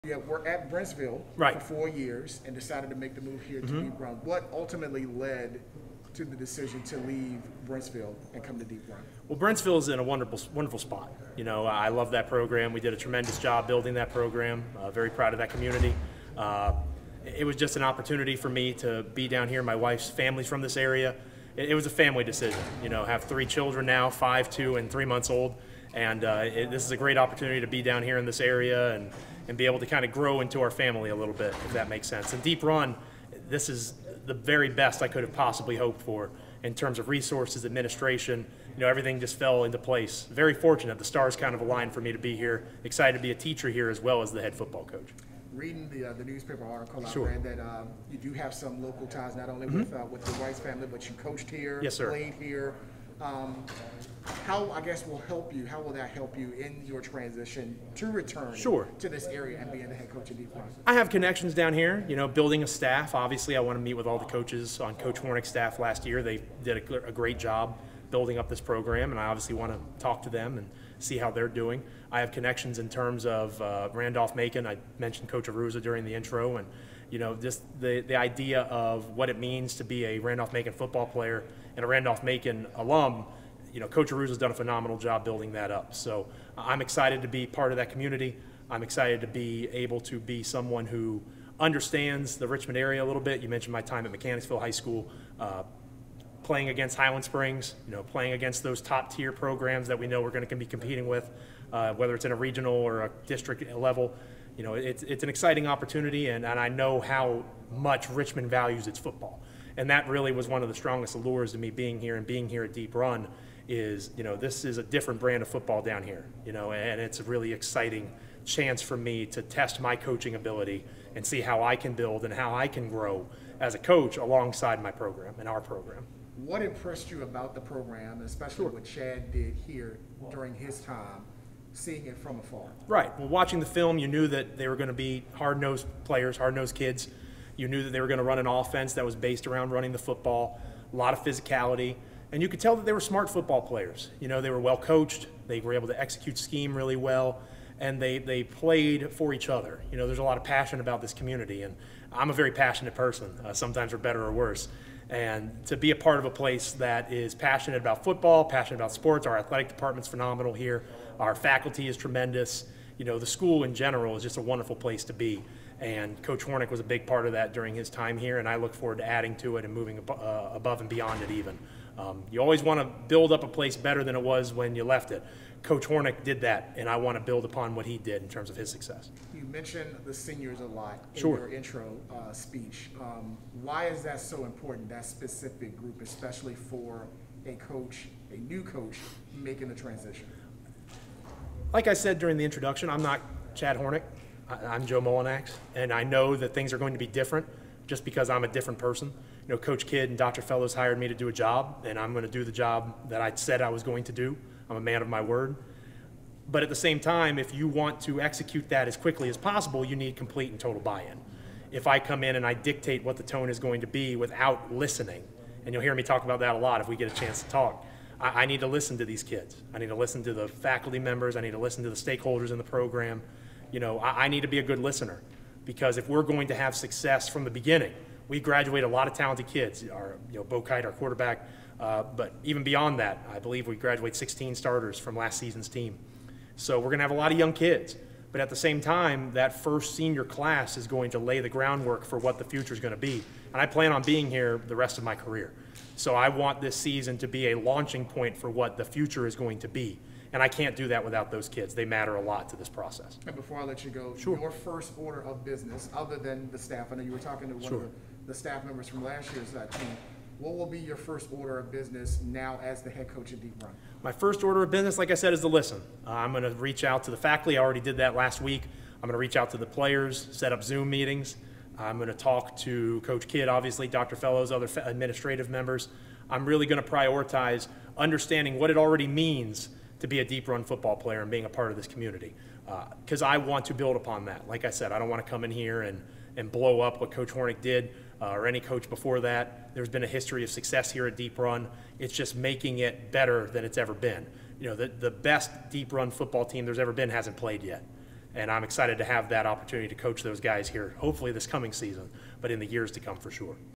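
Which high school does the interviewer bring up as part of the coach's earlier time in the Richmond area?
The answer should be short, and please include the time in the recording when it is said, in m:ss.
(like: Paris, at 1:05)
Mechanicsville High School, at 1:34.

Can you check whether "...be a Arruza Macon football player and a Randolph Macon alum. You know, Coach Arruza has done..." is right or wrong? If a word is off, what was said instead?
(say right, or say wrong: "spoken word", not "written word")
wrong: "Randolph", not "Arruza".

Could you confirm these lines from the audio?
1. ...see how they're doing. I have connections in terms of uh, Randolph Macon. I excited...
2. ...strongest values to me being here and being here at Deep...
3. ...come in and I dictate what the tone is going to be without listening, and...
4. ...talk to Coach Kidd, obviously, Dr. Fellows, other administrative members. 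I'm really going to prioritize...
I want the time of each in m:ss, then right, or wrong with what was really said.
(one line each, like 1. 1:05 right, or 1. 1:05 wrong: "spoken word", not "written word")
1. 1:10 wrong: "mentioned", not "excited"
2. 1:50 wrong: "allures", not "values"
3. 3:31 right
4. 4:32 right.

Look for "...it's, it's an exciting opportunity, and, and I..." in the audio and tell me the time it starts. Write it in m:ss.
1:44.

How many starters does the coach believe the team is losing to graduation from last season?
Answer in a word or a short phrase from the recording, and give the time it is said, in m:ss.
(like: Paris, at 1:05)
16, at 3:54.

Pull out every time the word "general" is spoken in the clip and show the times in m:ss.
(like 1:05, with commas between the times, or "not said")
2:43.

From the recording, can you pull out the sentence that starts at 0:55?
How will that help you in your transition to return sure.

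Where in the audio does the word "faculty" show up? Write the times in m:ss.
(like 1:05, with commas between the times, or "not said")
2:41, 3:40, 4:27.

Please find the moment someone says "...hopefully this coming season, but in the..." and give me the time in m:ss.
5:00.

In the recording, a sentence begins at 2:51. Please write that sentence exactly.
Um, you always want to build up a place better than it was when you left it.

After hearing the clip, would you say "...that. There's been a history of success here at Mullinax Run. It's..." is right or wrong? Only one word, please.
wrong.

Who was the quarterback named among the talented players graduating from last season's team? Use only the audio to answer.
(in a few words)
Bo Kite.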